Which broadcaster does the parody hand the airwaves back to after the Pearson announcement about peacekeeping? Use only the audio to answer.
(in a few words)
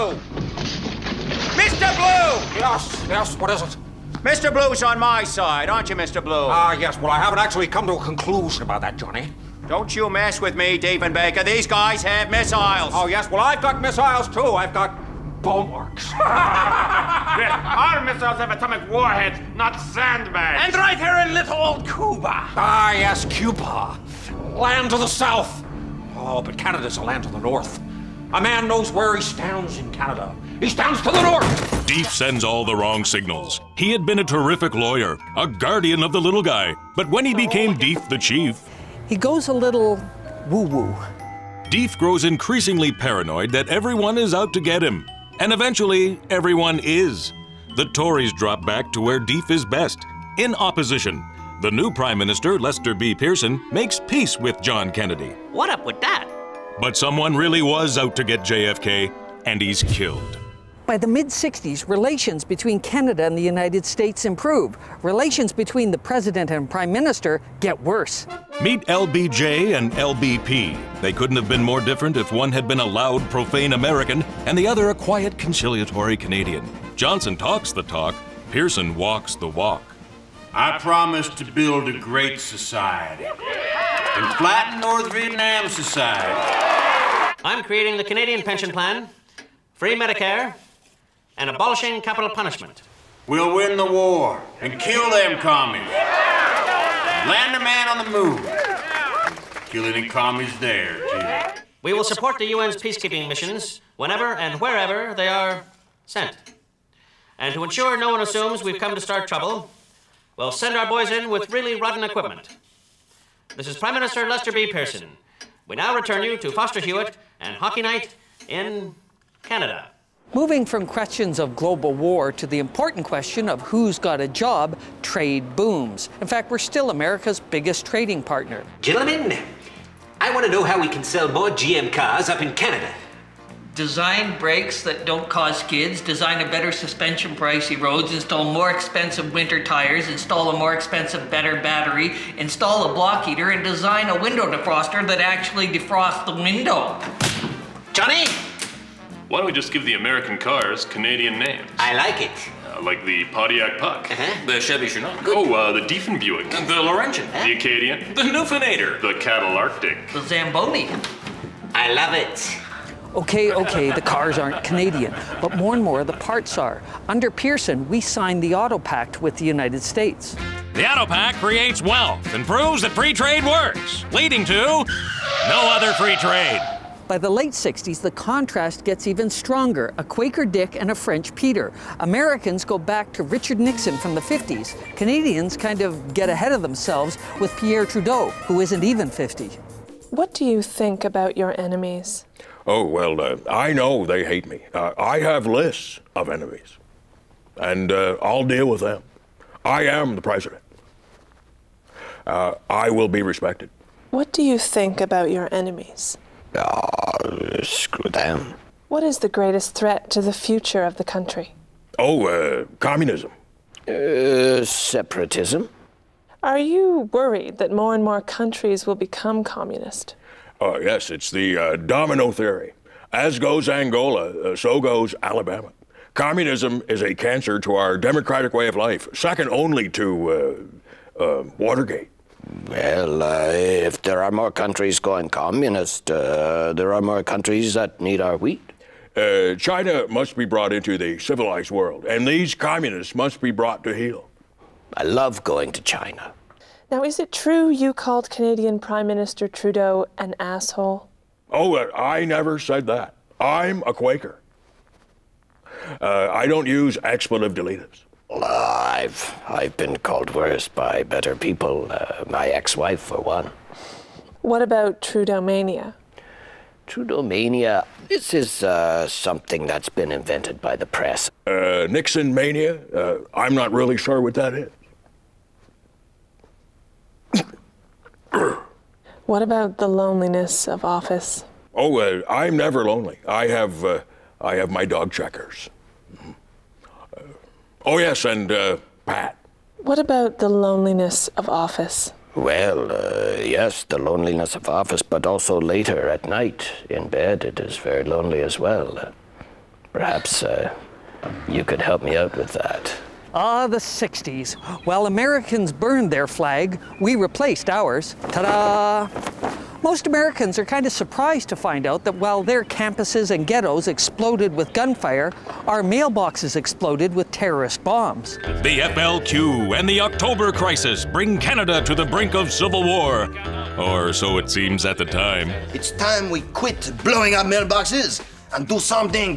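Foster Hewitt.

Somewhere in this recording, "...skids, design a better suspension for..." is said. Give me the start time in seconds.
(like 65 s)
135 s.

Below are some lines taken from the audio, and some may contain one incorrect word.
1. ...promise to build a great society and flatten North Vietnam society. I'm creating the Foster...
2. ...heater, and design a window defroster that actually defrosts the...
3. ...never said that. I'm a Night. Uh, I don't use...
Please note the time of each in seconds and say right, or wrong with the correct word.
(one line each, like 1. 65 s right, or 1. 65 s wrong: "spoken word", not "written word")
1. 80 s wrong: "Canadian", not "Foster"
2. 143 s right
3. 252 s wrong: "Quaker", not "Night".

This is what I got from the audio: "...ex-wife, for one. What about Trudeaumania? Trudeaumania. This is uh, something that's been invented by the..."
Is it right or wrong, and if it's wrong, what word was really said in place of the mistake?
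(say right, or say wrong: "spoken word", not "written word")
right.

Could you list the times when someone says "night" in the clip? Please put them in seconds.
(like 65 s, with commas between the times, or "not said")
117 s, 296 s.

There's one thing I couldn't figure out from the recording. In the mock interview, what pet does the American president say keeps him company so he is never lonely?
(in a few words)
Checkers.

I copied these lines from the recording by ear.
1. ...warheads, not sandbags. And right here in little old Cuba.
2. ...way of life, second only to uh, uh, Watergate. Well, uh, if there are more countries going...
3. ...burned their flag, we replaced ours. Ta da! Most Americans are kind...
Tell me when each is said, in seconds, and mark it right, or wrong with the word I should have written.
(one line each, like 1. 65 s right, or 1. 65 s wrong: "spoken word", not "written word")
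1. 18 s right
2. 228 s right
3. 305 s right.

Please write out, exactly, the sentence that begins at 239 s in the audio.
Uh, China must be brought into the civilized world, and these communists must be brought to heel.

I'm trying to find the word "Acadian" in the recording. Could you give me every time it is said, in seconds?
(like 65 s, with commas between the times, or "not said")
157 s.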